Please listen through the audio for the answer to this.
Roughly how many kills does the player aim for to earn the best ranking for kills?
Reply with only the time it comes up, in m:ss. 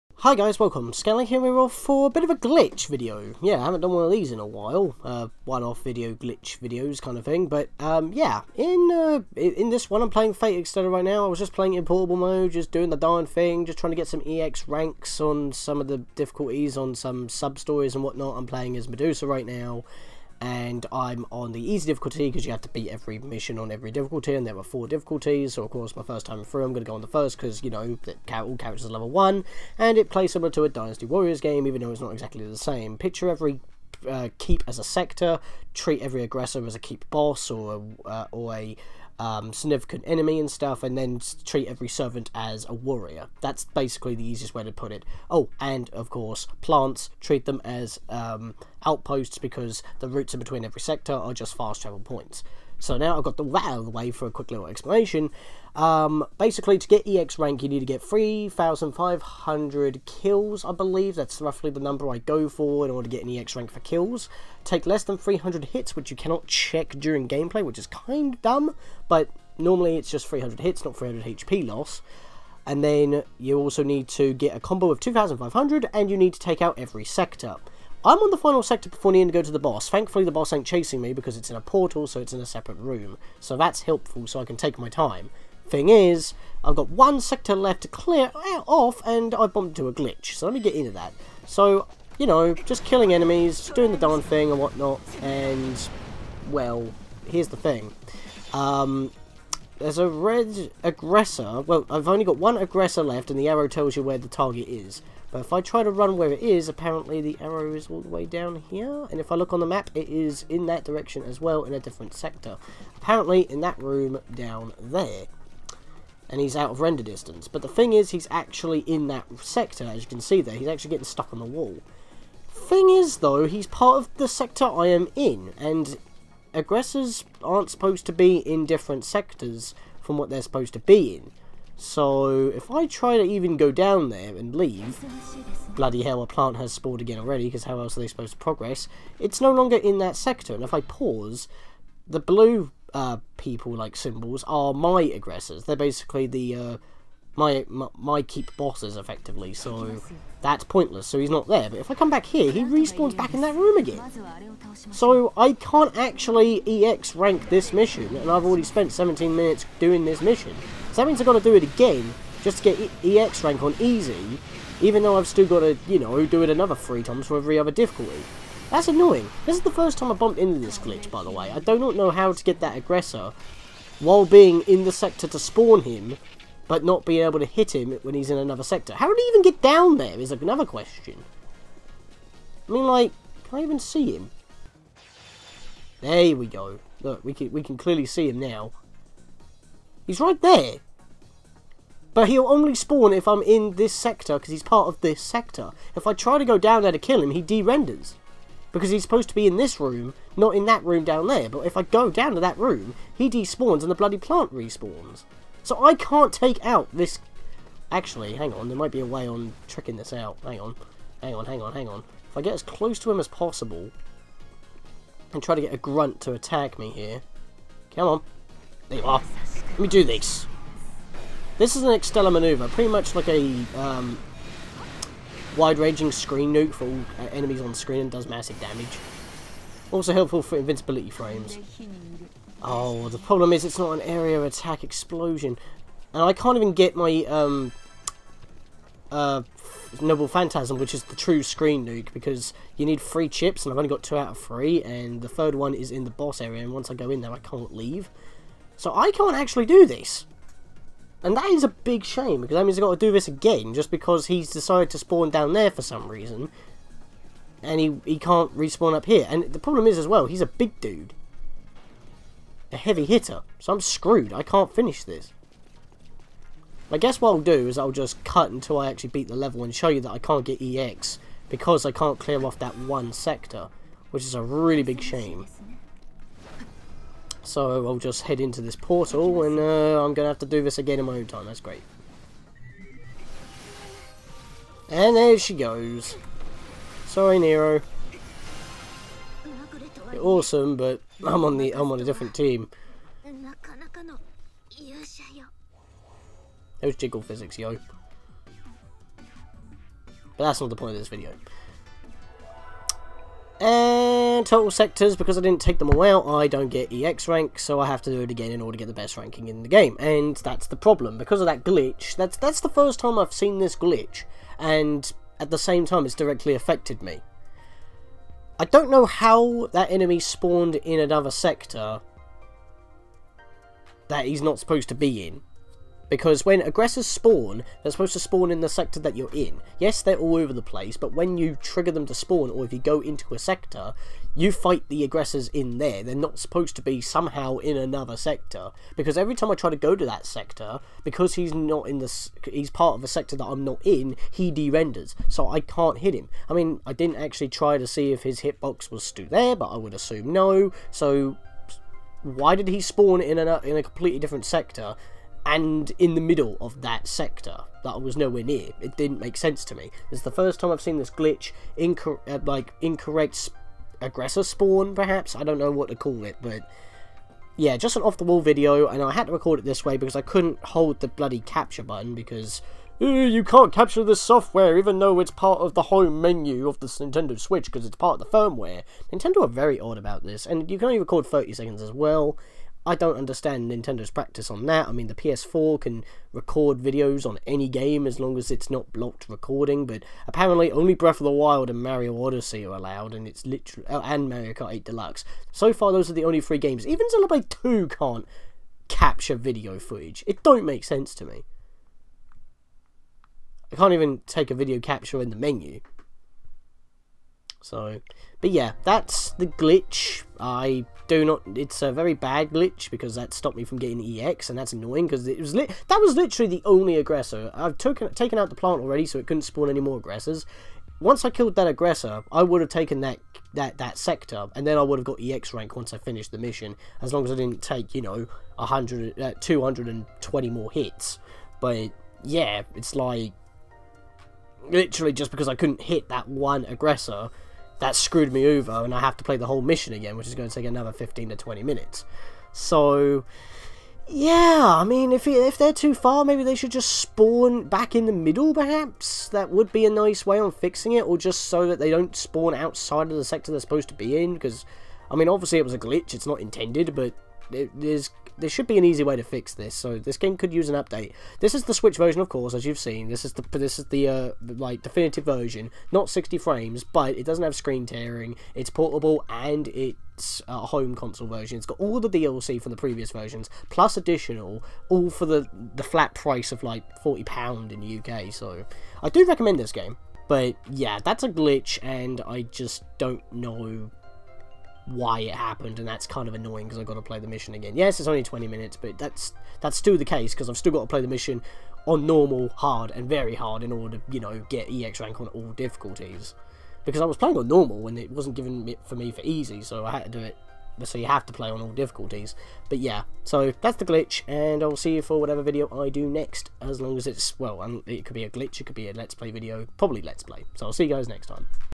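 0:58.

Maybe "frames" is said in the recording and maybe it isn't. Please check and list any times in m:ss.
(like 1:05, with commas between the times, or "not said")
3:51, 7:46.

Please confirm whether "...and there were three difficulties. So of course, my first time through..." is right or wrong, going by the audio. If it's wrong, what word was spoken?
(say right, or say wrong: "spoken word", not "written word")
wrong: "four", not "three".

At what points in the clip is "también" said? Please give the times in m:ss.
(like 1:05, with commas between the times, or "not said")
not said.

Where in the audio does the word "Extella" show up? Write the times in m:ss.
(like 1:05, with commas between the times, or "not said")
0:10, 3:41.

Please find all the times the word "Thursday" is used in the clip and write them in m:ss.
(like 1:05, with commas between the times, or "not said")
not said.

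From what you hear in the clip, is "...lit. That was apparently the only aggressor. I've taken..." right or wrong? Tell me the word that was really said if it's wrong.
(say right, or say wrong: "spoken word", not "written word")
wrong: "literally", not "apparently".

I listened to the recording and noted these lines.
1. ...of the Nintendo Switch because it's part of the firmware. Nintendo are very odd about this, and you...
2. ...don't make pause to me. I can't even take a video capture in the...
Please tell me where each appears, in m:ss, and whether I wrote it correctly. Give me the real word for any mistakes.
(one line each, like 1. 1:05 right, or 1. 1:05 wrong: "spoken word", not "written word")
1. 6:16 right
2. 6:40 wrong: "sense", not "pause".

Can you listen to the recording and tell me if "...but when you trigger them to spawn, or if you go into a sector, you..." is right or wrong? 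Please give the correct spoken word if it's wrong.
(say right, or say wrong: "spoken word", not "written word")
right.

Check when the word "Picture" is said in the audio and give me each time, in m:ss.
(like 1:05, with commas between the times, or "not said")
0:32.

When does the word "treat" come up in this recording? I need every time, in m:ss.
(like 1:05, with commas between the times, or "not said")
0:35, 0:41, 0:47.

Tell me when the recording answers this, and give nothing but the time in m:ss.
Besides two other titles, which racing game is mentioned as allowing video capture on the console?
6:34.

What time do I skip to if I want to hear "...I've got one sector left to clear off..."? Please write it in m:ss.
1:26.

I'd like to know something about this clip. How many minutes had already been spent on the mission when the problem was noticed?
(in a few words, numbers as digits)
17 minutes.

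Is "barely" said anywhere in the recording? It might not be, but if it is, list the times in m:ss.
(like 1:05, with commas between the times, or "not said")
not said.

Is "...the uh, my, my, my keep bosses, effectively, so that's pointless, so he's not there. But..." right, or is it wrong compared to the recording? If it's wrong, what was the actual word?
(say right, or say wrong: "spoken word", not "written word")
right.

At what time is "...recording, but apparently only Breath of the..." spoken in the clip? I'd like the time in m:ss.
6:29.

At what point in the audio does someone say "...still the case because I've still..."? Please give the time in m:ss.
8:09.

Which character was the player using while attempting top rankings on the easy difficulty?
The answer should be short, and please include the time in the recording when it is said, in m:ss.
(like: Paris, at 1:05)
Medusa, at 0:18.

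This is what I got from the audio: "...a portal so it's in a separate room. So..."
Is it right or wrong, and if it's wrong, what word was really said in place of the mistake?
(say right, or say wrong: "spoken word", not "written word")
right.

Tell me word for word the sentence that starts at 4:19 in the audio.
And the problem is as well, he's a big dude.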